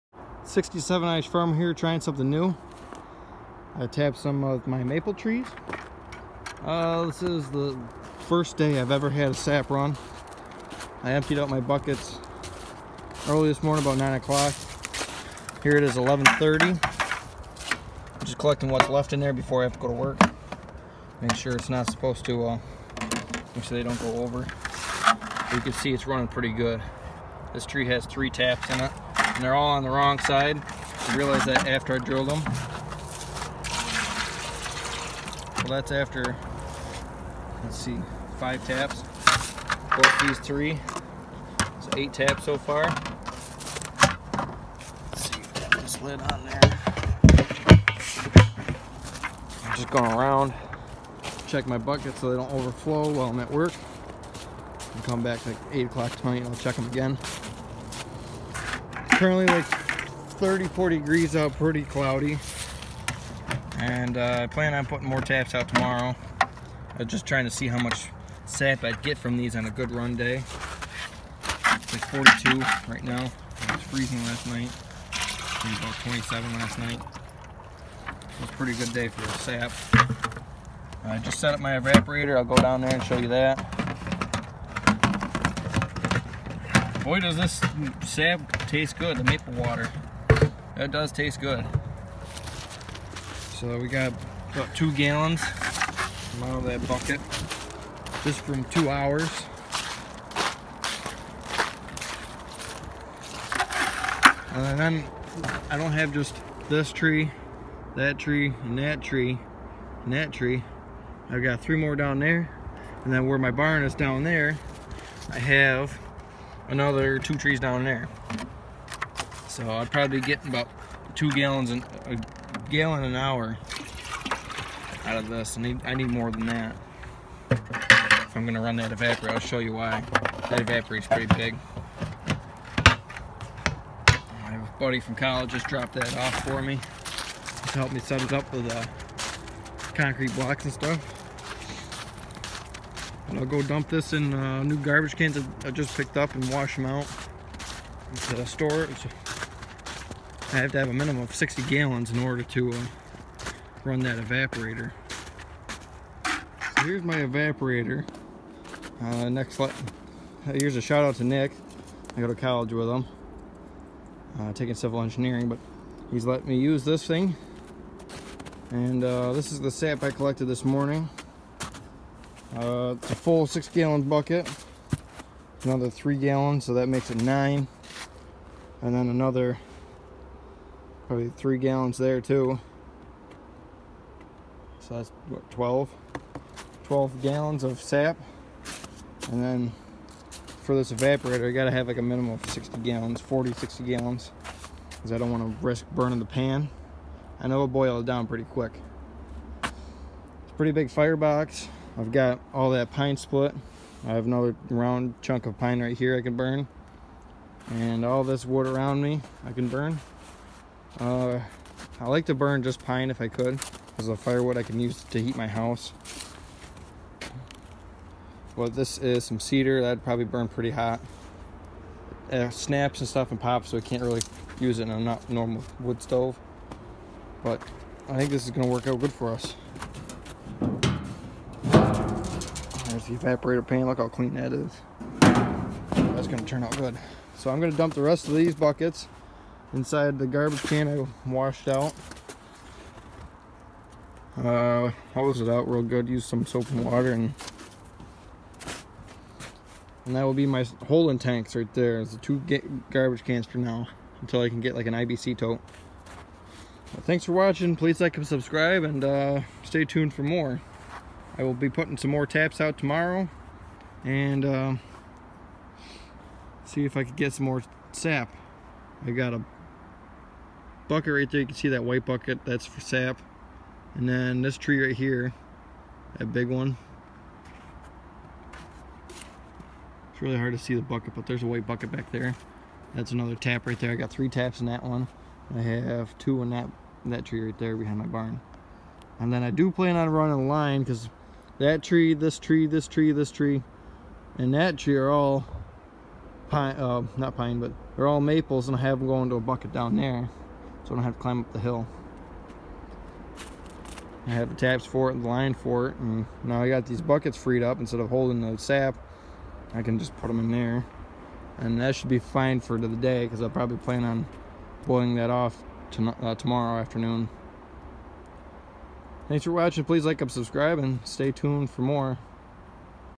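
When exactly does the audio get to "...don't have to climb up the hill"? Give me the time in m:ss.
5:00.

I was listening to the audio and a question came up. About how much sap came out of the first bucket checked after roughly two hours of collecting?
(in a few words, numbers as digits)
2 gallons.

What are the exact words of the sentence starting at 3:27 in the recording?
And all this wood around me I can burn.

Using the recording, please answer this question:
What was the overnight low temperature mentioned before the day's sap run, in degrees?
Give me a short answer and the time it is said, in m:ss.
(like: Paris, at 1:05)
27, at 1:15.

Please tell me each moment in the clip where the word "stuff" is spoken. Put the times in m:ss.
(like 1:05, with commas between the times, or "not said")
2:20, 3:43.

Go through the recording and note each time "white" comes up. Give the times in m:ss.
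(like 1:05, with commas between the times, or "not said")
4:31, 4:41.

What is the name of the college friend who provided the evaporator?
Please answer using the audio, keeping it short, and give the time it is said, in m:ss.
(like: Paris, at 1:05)
Nick, at 2:41.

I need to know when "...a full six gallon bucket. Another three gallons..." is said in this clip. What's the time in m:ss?
2:53.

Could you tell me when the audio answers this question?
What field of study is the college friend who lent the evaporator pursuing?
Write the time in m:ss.
2:44.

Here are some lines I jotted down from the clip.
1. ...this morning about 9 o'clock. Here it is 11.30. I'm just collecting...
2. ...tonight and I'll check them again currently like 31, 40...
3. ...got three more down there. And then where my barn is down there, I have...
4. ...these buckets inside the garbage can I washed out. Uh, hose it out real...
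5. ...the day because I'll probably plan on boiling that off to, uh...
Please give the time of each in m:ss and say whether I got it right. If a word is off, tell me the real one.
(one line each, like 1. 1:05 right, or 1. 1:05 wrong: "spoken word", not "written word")
1. 0:13 right
2. 0:56 wrong: "30", not "31"
3. 1:51 right
4. 3:58 right
5. 5:12 right.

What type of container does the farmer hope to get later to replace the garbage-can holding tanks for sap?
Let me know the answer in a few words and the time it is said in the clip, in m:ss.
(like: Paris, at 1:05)
IBC tote, at 4:14.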